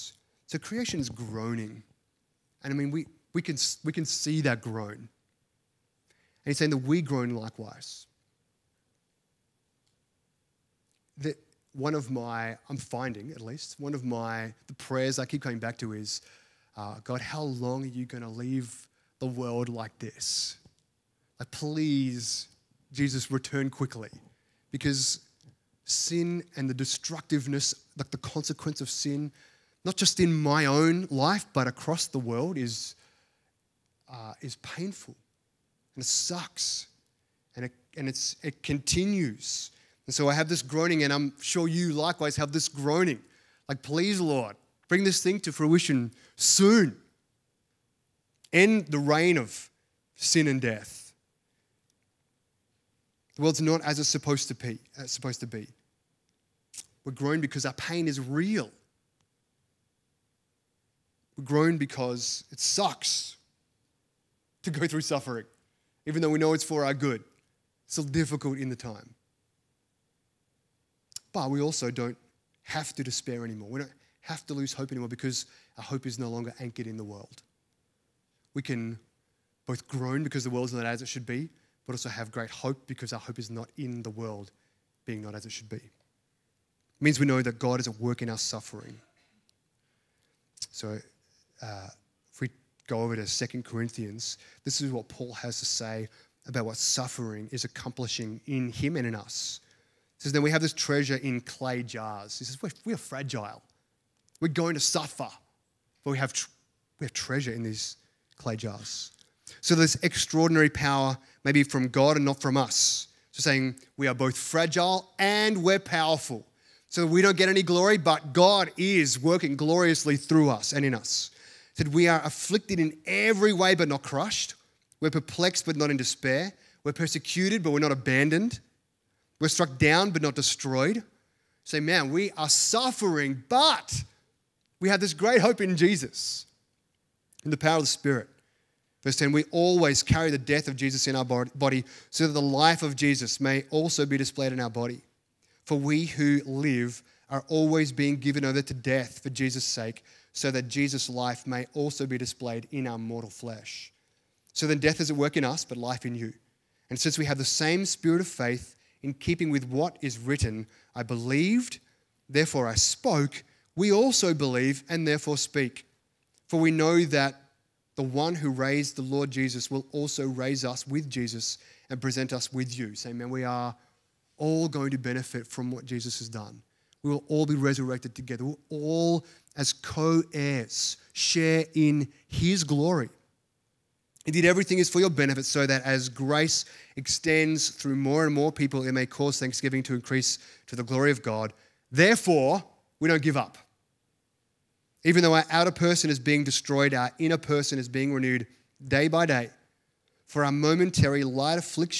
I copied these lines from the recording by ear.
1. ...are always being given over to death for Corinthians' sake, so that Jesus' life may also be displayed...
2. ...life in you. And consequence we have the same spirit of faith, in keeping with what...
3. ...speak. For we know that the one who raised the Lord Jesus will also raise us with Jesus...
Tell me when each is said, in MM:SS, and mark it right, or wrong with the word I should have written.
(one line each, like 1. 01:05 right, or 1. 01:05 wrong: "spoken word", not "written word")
1. 02:27 wrong: "Jesus", not "Corinthians"
2. 02:35 wrong: "since", not "consequence"
3. 02:45 right.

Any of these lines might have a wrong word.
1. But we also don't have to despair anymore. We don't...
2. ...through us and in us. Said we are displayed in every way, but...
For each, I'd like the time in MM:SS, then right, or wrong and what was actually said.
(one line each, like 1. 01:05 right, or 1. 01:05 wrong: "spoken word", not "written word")
1. 01:11 right
2. 02:00 wrong: "afflicted", not "displayed".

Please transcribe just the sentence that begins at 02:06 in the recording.
We're persecuted, but we're not abandoned.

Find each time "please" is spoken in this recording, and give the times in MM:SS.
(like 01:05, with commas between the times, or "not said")
00:21, 00:43.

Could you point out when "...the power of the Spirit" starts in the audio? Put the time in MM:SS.
02:17.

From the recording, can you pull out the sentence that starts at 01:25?
It means we know that God is at work in our suffering.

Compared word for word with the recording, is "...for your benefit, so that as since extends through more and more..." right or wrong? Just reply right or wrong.
wrong.